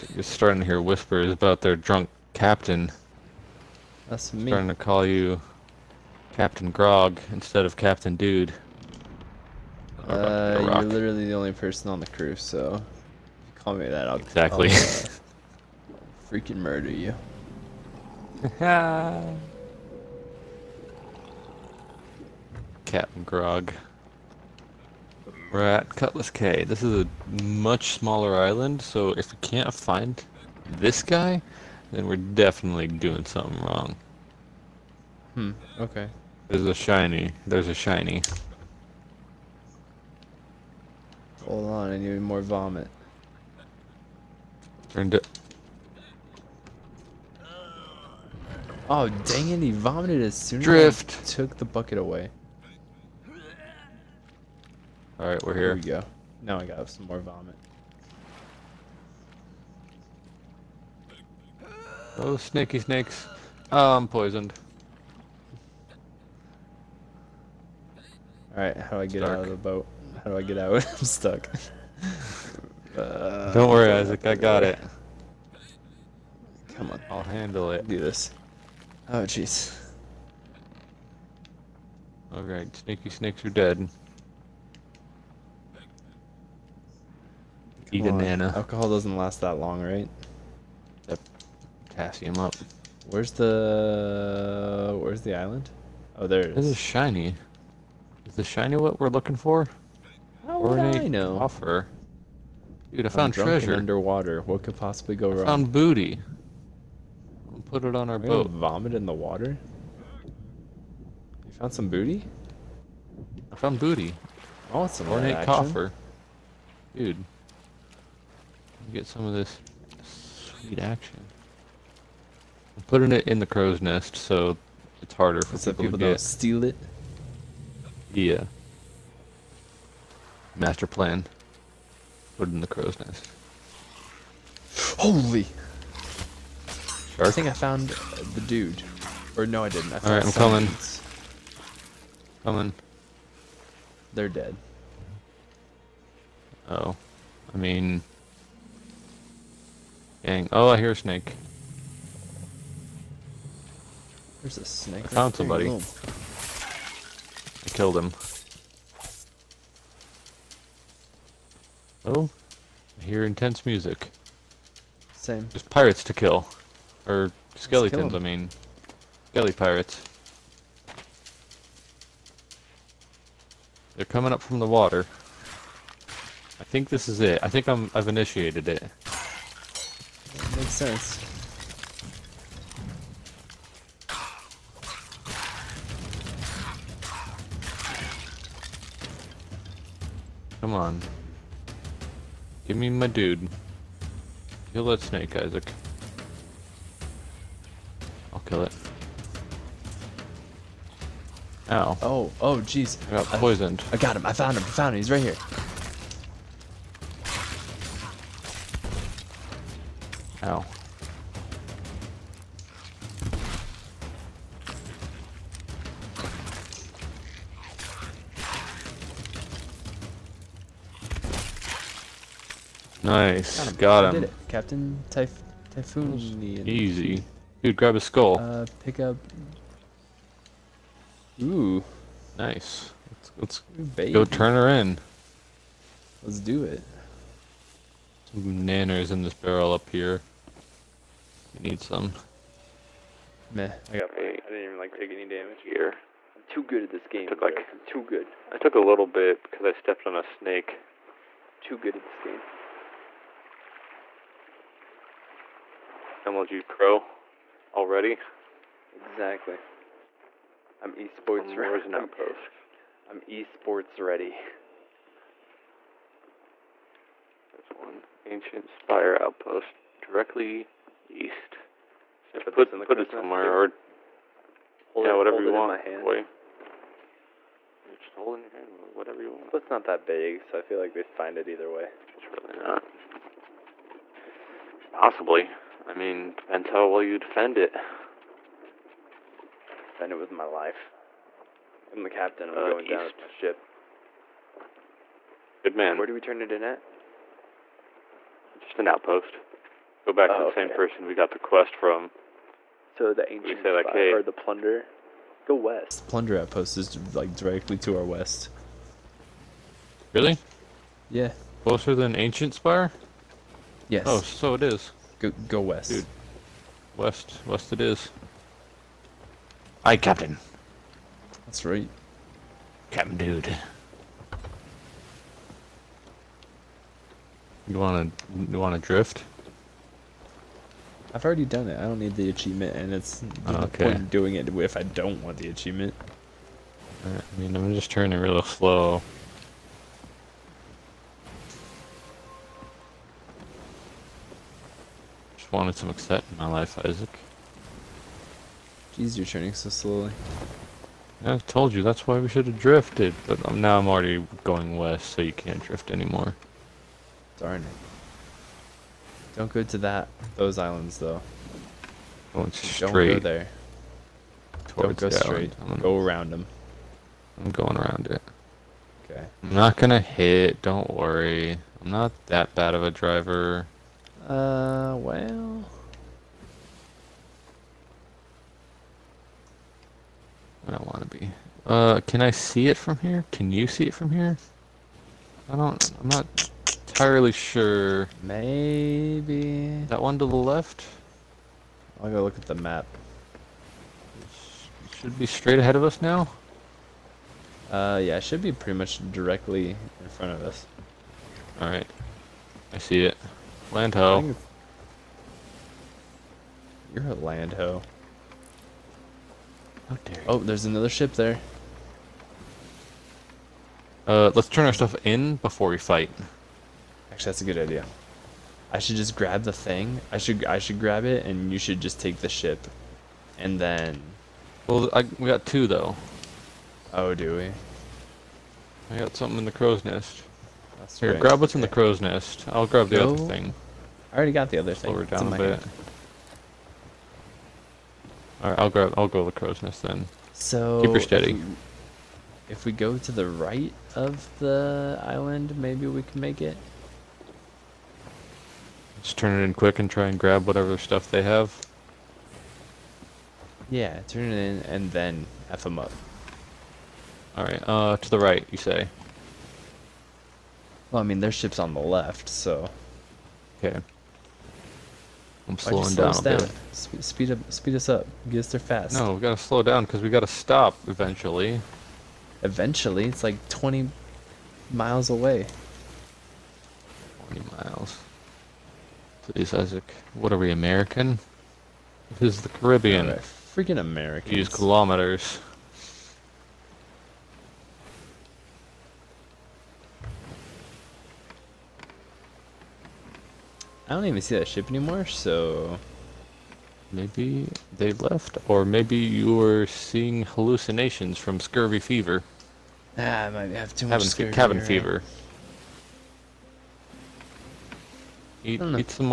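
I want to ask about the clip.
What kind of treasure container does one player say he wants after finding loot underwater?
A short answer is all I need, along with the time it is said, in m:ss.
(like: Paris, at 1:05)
ornate coffer, at 1:55.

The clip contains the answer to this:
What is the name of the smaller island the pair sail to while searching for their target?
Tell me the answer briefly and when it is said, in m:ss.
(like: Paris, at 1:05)
Cutlass Cay, at 0:25.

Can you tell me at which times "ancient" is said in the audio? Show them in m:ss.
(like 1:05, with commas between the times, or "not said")
4:28, 5:03, 5:12.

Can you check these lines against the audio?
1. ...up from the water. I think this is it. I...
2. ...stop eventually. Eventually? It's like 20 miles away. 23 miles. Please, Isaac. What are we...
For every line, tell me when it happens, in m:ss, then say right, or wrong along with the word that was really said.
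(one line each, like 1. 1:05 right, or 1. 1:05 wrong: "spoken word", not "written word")
1. 2:54 right
2. 7:50 wrong: "20", not "23".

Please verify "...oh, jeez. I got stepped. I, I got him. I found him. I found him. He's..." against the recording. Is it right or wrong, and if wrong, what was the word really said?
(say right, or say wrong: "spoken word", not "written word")
wrong: "poisoned", not "stepped".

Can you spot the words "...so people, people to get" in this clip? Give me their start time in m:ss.
2:05.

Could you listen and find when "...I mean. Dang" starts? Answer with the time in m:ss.
2:27.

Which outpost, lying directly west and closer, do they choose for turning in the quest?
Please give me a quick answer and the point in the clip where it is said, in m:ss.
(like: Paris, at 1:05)
Plunder outpost, at 5:06.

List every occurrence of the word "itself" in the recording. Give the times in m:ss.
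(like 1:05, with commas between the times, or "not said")
not said.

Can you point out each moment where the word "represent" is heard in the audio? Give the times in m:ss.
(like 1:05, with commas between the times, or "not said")
not said.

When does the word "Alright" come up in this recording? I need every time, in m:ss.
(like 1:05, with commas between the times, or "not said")
1:08, 1:22, 6:41, 7:37.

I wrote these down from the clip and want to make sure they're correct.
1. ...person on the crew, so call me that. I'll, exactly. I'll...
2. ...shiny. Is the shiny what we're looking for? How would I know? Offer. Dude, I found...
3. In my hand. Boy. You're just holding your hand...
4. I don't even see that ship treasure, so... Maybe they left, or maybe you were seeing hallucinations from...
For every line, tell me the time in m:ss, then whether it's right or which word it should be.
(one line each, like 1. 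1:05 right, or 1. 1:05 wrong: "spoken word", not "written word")
1. 0:11 right
2. 1:36 right
3. 4:35 right
4. 8:13 wrong: "anymore", not "treasure".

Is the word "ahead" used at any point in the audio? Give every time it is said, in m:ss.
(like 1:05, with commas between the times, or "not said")
6:35.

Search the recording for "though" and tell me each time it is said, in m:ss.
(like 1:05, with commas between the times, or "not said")
6:00, 7:05.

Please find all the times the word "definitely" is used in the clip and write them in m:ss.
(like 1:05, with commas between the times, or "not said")
0:32.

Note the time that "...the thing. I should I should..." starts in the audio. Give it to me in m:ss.
6:59.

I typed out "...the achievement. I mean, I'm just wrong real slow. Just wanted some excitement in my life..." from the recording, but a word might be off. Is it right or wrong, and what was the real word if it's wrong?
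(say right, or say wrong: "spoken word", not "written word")
wrong: "turning", not "wrong".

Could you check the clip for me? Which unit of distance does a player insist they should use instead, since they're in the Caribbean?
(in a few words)
kilometers.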